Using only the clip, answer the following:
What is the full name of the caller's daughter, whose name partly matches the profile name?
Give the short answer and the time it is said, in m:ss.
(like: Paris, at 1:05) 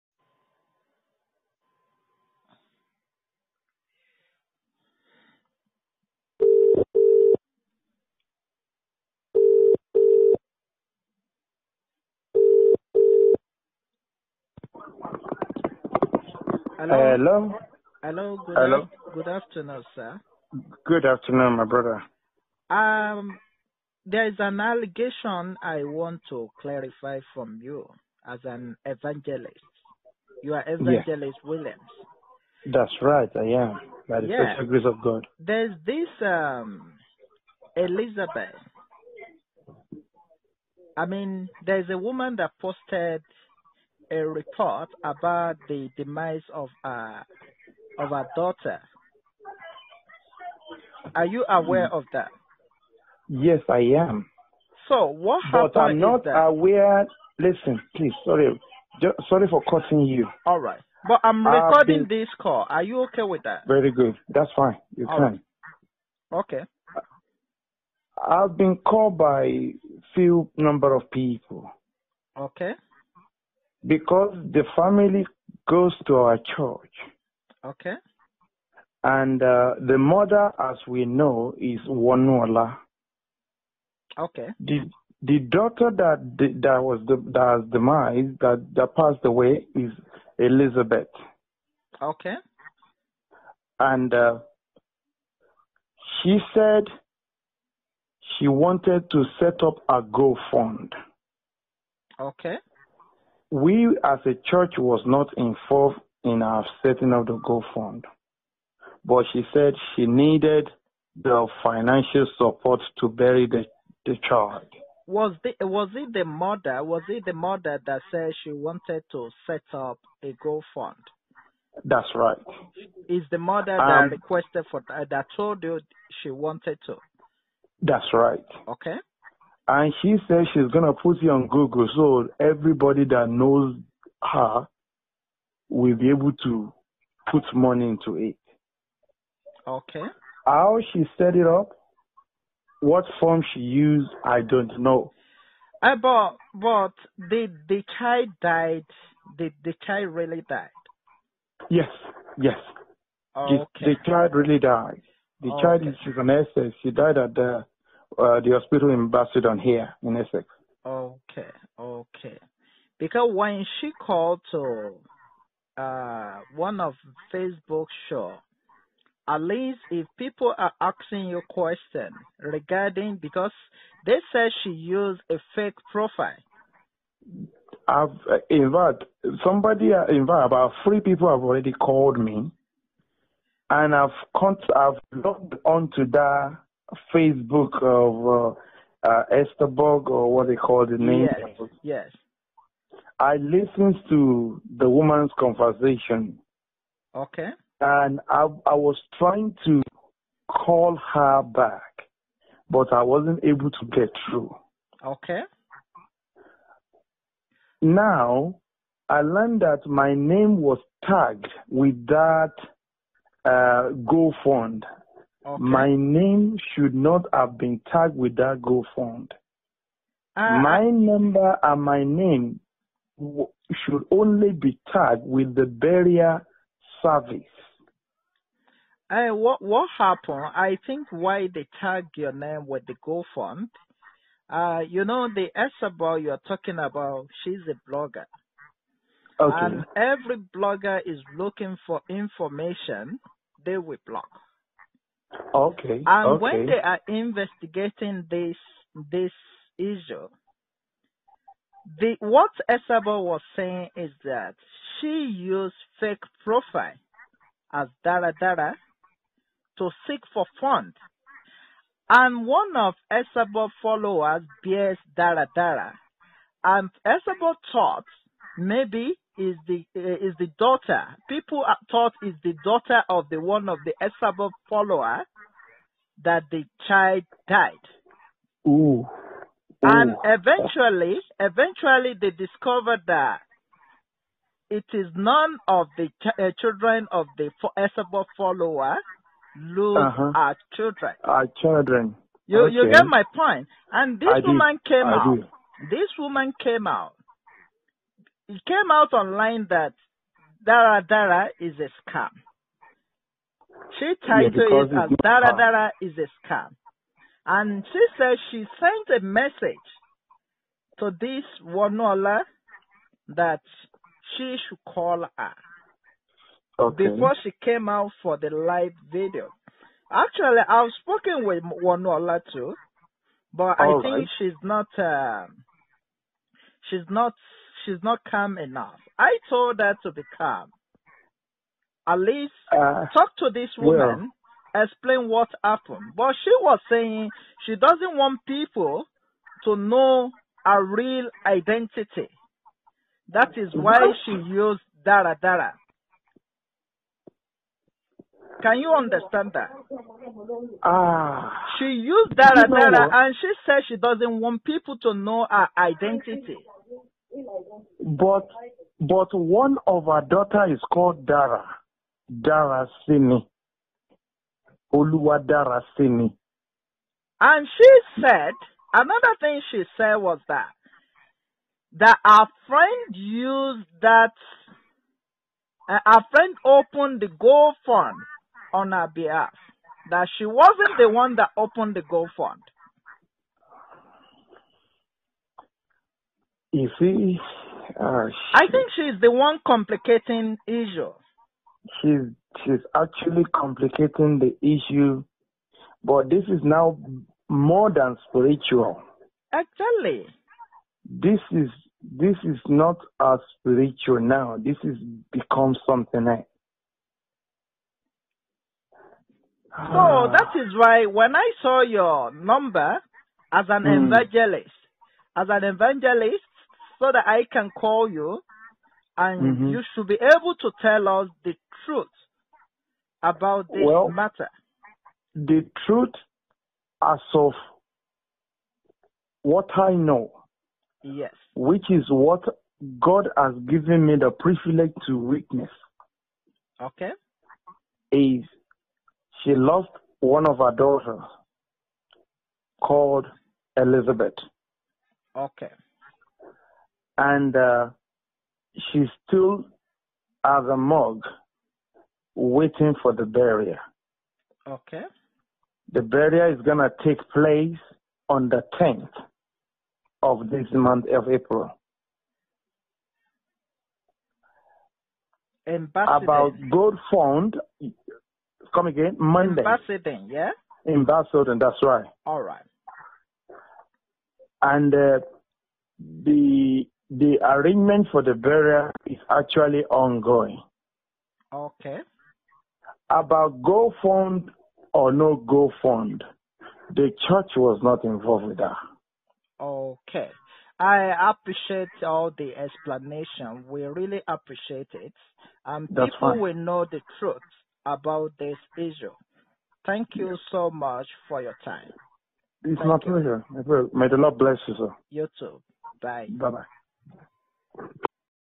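Oluwa Dara Simi, at 6:04.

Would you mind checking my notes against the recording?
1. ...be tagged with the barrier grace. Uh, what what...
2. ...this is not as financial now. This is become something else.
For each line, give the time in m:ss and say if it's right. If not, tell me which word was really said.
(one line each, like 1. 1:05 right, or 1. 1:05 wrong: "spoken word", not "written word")
1. 3:44 wrong: "service", not "grace"
2. 6:42 wrong: "spiritual", not "financial".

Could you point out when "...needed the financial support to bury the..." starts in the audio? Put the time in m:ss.
1:50.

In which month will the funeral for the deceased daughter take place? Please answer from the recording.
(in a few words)
April.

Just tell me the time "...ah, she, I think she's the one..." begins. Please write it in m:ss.
6:28.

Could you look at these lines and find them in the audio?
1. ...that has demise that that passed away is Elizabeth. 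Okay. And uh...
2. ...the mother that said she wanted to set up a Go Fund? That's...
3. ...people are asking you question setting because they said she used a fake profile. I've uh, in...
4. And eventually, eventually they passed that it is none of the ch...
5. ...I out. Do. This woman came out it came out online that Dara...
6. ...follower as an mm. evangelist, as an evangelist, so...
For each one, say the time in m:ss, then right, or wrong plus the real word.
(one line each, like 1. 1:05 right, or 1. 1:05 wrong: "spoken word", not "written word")
1. 1:27 right
2. 1:57 right
3. 2:50 wrong: "regarding", not "setting"
4. 4:39 wrong: "discovered", not "passed"
5. 4:55 right
6. 6:52 wrong: "number", not "follower".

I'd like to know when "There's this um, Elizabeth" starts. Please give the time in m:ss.
0:35.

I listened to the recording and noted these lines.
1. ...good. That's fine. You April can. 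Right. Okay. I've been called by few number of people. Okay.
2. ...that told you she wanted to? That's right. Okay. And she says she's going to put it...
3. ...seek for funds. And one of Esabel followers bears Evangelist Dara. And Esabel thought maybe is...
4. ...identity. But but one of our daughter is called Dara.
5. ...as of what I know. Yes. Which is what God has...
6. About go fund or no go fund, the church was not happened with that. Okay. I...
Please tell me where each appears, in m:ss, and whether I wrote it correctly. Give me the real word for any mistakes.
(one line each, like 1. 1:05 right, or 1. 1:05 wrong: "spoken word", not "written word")
1. 1:03 wrong: "All", not "April"
2. 2:05 right
3. 4:20 wrong: "Dara", not "Evangelist"
4. 5:55 right
5. 7:07 right
6. 8:03 wrong: "involved", not "happened".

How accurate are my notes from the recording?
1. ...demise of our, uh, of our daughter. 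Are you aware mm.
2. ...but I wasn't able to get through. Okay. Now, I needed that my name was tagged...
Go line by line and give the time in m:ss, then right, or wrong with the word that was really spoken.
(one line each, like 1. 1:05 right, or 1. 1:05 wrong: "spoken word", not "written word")
1. 0:45 right
2. 3:22 wrong: "learned", not "needed".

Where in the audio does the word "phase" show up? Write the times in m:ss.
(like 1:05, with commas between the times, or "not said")
not said.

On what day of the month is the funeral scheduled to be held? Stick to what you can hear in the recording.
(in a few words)
10th.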